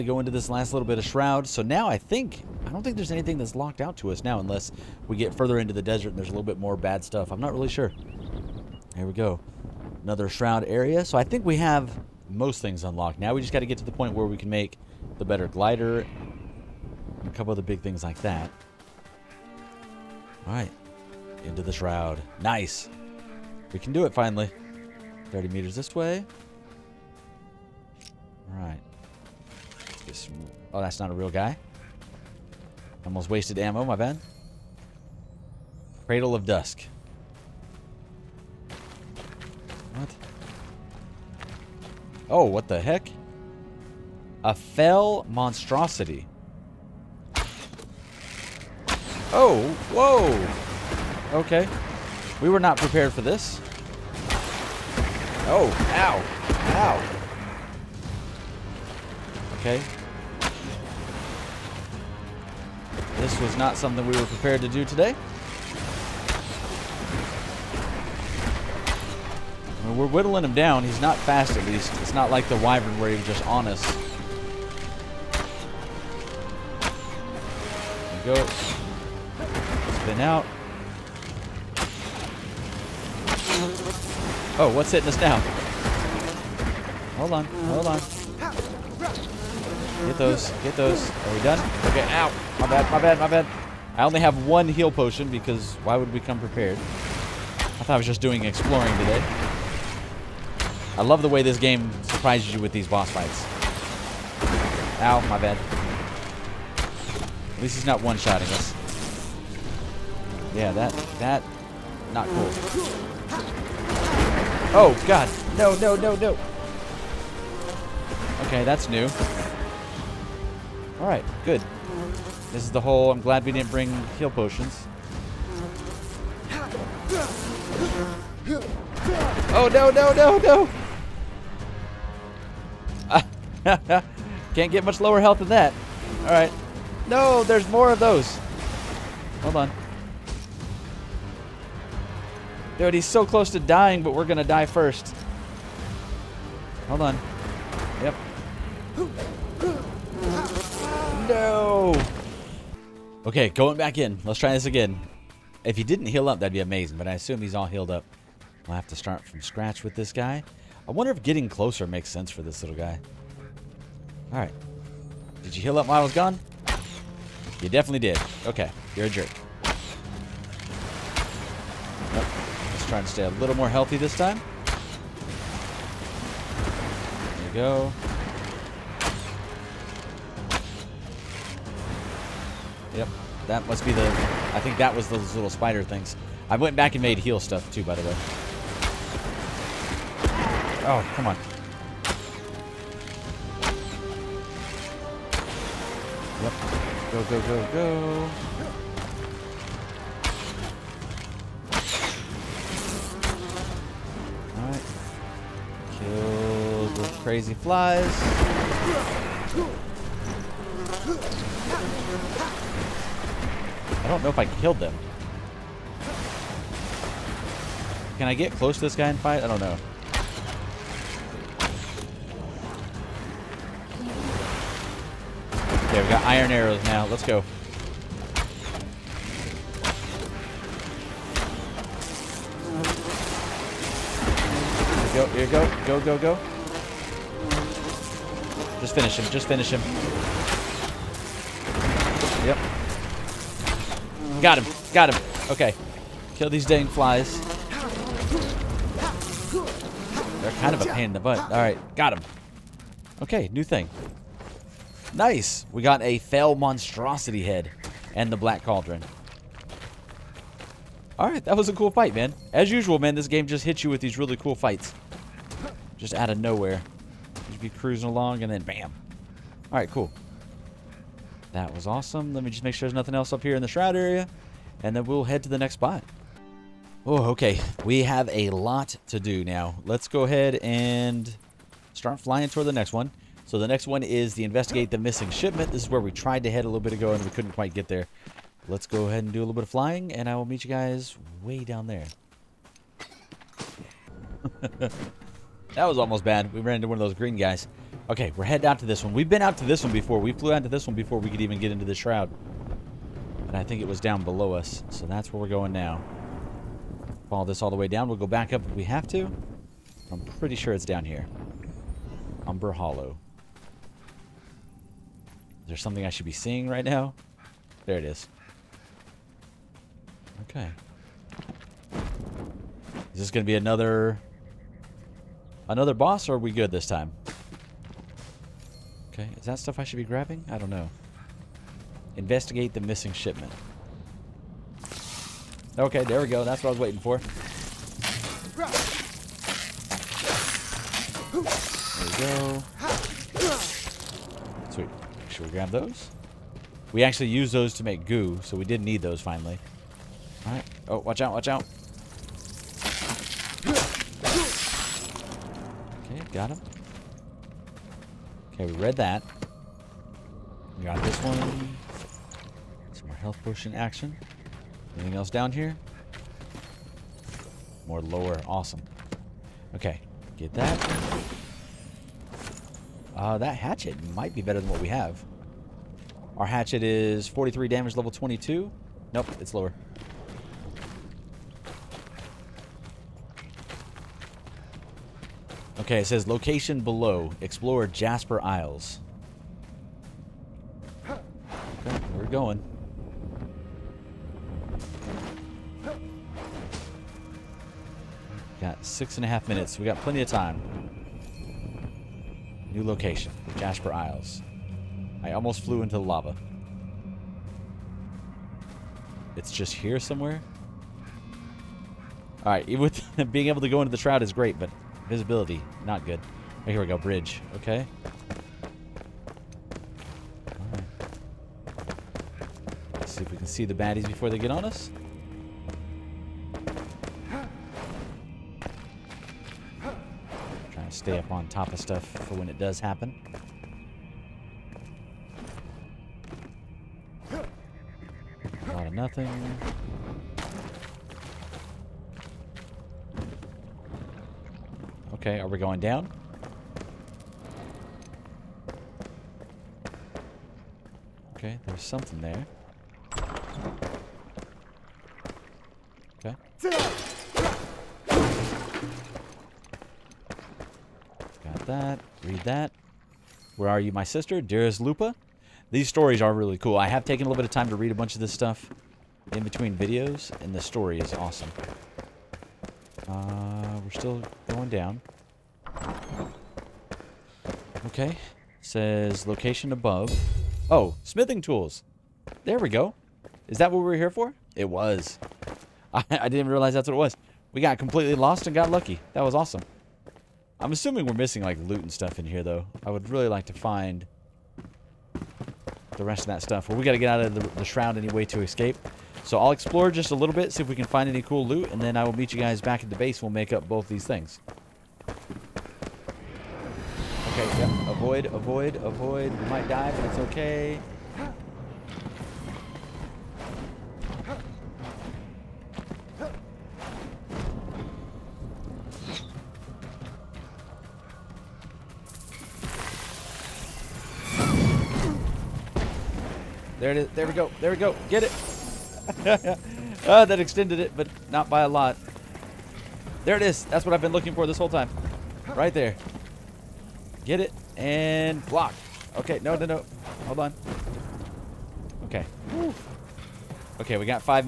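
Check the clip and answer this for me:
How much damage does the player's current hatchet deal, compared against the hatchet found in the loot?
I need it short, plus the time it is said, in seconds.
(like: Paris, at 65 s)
43, at 377 s.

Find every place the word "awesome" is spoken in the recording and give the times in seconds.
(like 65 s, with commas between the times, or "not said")
271 s, 368 s, 471 s, 489 s.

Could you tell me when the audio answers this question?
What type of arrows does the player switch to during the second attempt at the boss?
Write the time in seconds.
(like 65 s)
226 s.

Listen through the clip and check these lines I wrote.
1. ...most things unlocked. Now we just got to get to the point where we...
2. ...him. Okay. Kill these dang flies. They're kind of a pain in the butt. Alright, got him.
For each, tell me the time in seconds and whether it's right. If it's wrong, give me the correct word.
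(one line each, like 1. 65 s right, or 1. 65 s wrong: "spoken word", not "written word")
1. 12 s right
2. 245 s right.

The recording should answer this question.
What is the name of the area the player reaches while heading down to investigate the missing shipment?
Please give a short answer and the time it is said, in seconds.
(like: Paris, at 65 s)
Umberhollow, at 312 s.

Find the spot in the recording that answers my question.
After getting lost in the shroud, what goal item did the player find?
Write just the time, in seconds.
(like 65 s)
481 s.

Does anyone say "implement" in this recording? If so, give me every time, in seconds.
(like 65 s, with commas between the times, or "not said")
not said.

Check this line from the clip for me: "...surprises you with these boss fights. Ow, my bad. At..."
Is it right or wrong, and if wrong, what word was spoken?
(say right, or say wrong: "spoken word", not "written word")
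right.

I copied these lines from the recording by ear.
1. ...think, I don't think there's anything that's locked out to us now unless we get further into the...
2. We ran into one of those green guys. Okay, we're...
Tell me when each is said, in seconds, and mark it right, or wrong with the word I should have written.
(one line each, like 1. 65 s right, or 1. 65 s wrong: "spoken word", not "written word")
1. 1 s right
2. 296 s right.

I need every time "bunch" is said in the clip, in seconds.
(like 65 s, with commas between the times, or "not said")
467 s.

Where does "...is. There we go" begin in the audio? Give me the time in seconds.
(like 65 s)
526 s.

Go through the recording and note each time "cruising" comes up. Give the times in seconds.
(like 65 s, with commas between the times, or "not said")
267 s.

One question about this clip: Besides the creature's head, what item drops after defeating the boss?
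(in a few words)
Black Cauldron.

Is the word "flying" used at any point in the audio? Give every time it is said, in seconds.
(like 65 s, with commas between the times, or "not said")
282 s, 289 s.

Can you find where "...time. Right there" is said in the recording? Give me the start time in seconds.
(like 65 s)
534 s.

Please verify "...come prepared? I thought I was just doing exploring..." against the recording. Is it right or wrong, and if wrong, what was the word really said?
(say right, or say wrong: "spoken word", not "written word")
right.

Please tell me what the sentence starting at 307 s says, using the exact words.
Follow this all the way down.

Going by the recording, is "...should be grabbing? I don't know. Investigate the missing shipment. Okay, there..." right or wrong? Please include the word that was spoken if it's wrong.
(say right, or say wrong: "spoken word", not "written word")
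right.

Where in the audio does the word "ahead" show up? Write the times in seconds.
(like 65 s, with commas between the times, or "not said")
280 s, 289 s.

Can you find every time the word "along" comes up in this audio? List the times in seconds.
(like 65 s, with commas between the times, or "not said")
268 s.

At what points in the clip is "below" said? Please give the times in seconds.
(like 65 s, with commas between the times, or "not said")
304 s, 386 s.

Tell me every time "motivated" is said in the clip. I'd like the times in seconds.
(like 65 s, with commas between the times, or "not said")
not said.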